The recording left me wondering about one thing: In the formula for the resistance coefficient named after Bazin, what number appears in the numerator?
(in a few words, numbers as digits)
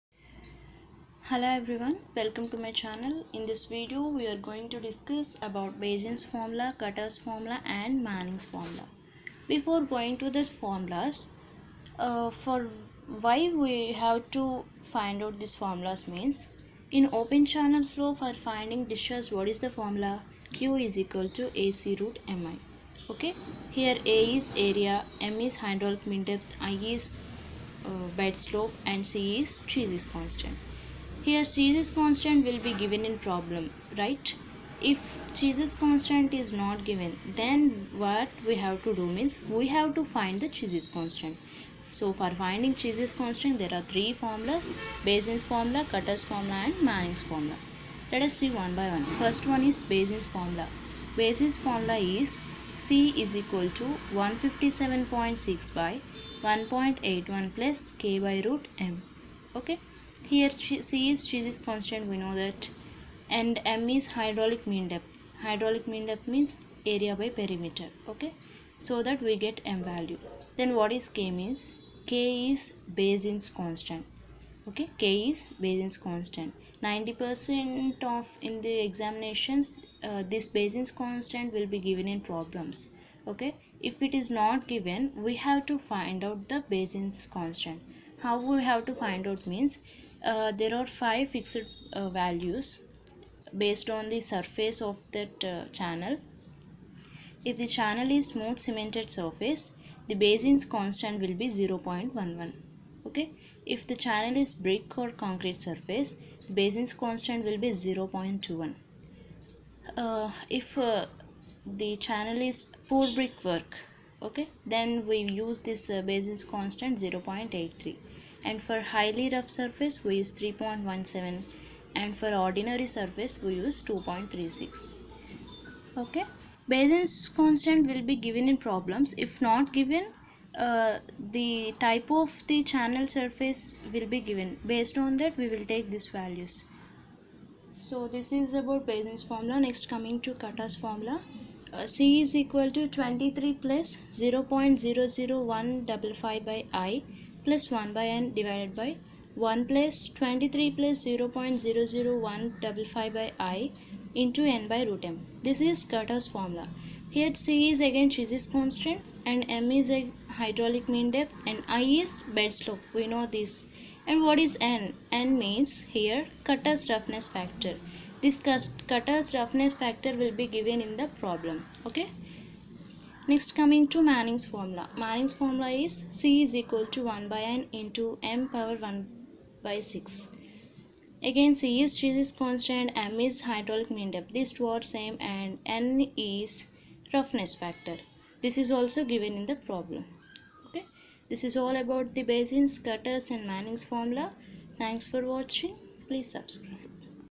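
157.6.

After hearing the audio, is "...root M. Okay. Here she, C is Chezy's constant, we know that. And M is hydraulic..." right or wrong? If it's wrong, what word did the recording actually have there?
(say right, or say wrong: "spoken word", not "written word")
right.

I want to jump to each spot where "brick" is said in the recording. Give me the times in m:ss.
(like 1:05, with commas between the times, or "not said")
1:44, 1:53.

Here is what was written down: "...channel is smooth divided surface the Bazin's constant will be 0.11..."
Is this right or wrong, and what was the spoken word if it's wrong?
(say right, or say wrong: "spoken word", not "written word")
wrong: "cemented", not "divided".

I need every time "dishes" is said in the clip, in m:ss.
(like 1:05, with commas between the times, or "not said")
0:18.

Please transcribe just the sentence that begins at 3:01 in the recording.
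Again C is stress constant, m is hydraulic mean depth.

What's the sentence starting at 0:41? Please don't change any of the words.
So for finding Chezy's constant, there are three formulas, Bazin's formula, Kutter's formula and Manning's formula.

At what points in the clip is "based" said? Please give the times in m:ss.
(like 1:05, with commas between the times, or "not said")
1:33, 2:14.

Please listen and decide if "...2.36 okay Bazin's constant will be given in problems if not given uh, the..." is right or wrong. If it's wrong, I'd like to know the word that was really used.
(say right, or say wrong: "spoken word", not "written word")
right.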